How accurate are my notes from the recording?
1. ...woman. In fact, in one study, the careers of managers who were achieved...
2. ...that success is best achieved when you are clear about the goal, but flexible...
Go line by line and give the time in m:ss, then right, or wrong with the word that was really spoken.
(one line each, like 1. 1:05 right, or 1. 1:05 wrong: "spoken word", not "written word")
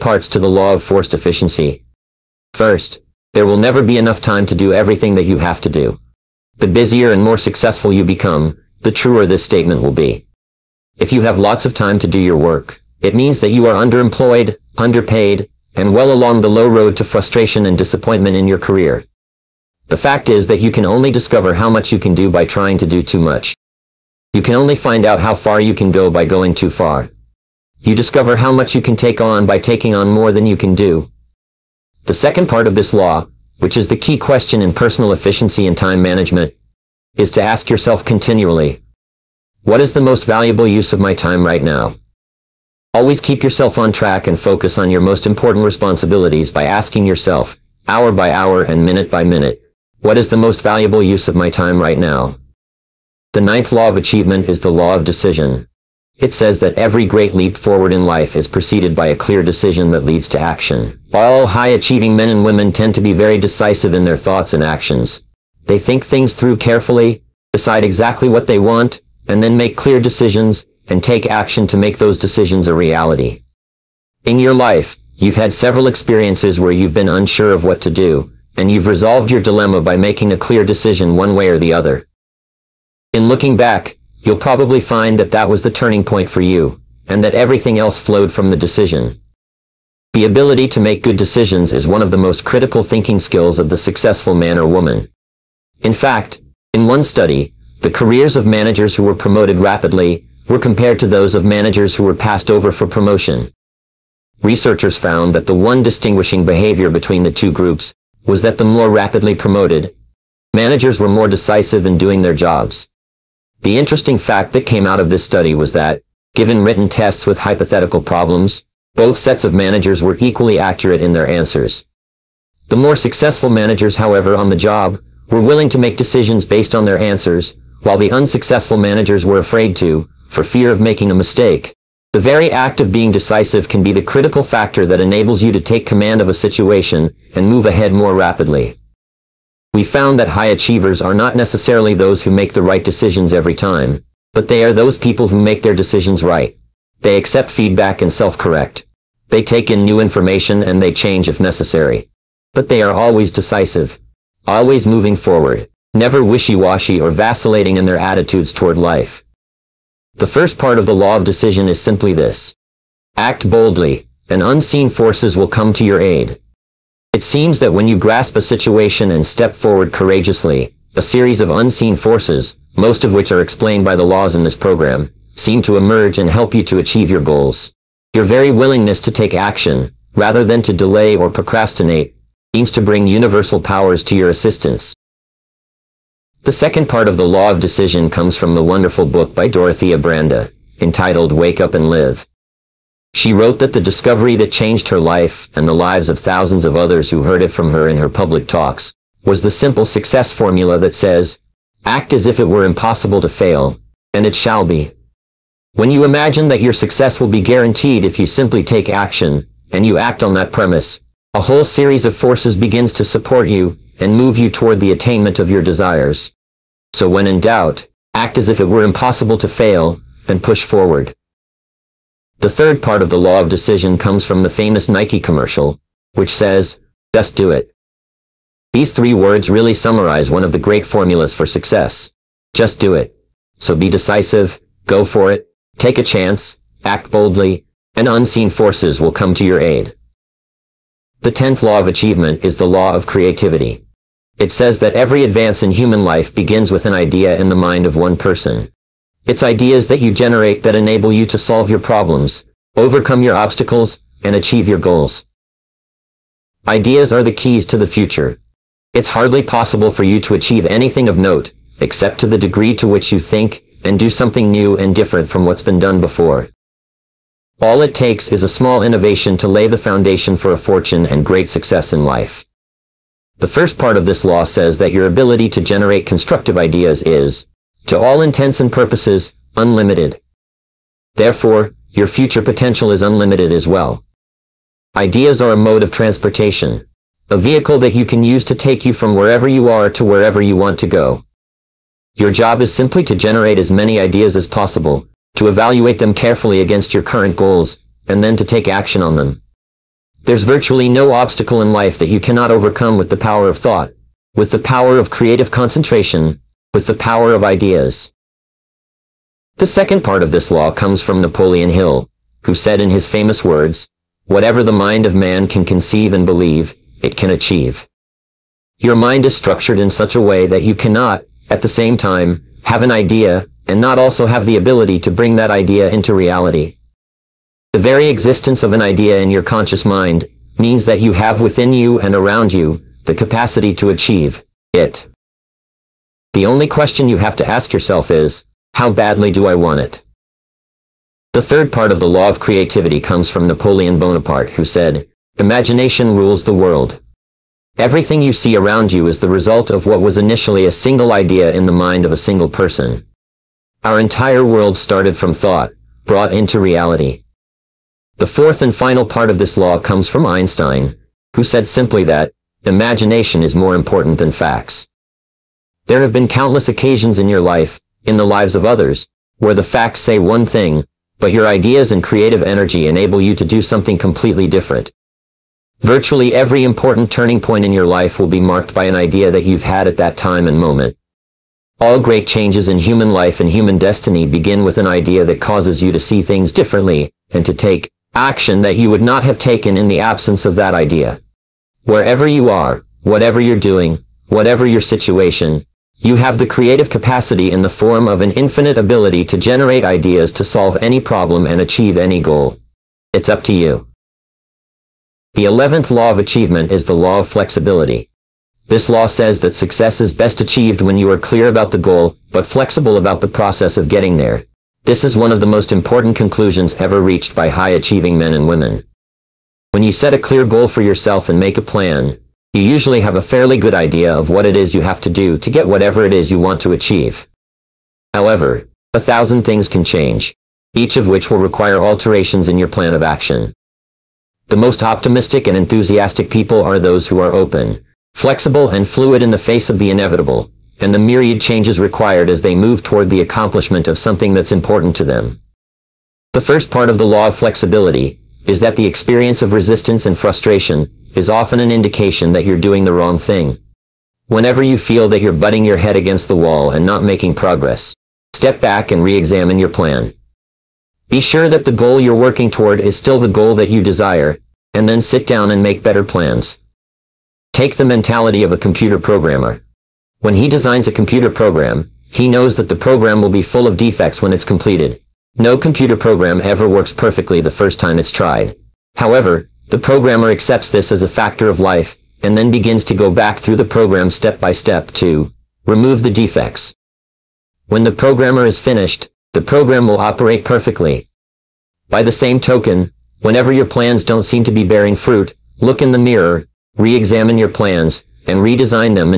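1. 1:34 wrong: "promoted", not "achieved"
2. 6:49 right.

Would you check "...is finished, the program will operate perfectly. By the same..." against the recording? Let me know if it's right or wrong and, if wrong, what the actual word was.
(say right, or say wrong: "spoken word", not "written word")
right.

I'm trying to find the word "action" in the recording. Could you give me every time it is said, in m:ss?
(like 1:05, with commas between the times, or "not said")
1:00, 1:04, 1:11, 2:59, 3:28, 4:58, 6:28, 7:13.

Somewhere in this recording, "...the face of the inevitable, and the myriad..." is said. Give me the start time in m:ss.
7:19.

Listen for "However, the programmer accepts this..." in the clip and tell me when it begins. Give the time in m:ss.
7:58.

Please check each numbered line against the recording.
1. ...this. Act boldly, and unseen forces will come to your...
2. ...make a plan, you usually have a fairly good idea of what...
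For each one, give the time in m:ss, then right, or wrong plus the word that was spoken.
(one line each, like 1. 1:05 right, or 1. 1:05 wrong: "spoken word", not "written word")
1. 2:42 right
2. 7:01 right.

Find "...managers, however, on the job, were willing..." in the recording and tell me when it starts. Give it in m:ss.
2:03.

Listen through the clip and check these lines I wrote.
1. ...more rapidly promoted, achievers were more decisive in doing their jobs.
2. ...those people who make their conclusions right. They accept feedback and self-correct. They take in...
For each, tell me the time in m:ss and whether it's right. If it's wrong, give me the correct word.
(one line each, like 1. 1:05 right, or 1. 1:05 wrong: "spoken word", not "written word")
1. 1:48 wrong: "managers", not "achievers"
2. 2:24 wrong: "decisions", not "conclusions".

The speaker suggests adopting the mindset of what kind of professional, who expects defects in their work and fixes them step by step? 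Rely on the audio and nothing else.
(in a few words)
Computer programmer.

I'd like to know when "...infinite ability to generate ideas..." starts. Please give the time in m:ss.
6:38.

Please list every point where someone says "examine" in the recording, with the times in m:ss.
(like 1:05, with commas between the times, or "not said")
7:39, 8:16.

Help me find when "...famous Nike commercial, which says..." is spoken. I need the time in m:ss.
3:44.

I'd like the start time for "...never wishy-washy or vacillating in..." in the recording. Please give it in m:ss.
2:35.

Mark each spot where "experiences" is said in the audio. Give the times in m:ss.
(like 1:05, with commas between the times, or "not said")
1:15, 7:28.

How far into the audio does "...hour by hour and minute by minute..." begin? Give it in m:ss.
0:47.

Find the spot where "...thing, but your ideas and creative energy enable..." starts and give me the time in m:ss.
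6:10.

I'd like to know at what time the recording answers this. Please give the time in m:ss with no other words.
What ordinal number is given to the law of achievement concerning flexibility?
6:45.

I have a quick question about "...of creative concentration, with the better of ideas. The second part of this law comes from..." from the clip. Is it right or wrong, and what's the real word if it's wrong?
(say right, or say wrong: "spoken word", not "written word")
wrong: "power", not "better".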